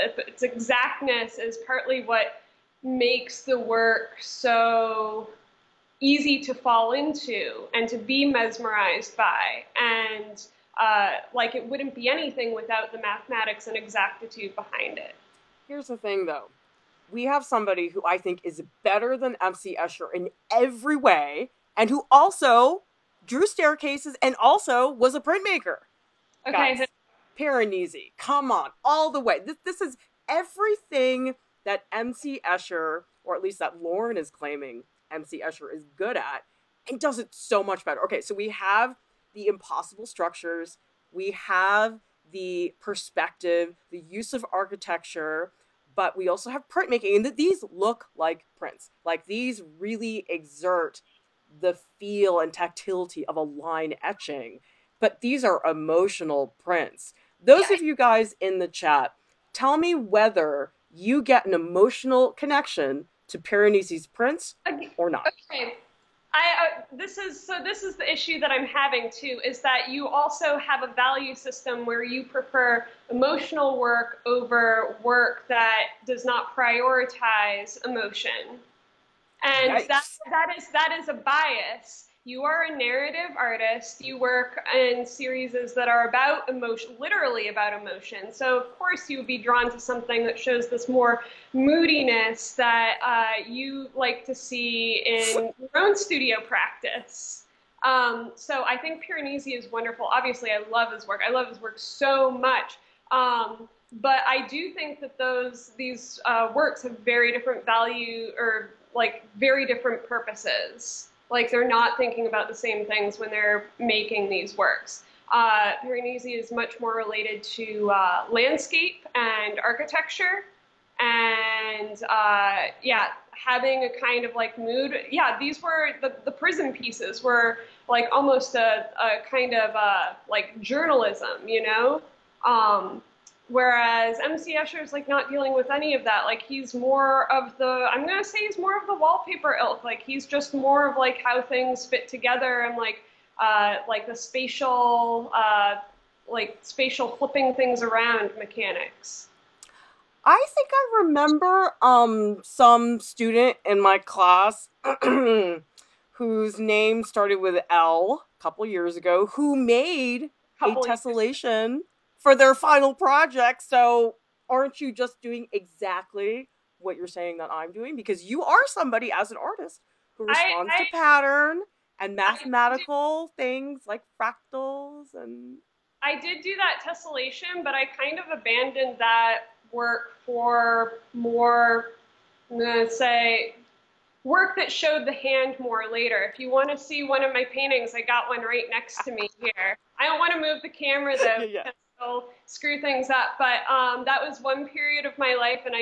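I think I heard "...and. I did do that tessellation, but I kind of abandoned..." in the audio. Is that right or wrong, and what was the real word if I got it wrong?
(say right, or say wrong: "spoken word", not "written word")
right.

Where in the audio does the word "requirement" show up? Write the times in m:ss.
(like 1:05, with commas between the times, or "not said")
not said.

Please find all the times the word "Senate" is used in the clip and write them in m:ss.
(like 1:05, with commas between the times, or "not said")
not said.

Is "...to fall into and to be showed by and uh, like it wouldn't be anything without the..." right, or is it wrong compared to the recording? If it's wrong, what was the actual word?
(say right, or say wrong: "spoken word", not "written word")
wrong: "mesmerized", not "showed".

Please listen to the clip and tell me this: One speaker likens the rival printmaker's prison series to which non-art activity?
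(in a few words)
journalism.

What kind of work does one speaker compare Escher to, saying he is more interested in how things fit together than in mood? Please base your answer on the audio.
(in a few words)
wallpaper.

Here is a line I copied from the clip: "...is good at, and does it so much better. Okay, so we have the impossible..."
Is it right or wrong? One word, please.
right.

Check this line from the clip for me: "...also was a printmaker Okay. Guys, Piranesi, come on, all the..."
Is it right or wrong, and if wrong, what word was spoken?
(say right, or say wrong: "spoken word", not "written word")
right.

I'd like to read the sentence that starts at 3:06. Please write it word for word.
If you want to see one of my paintings, I got one right next to me here.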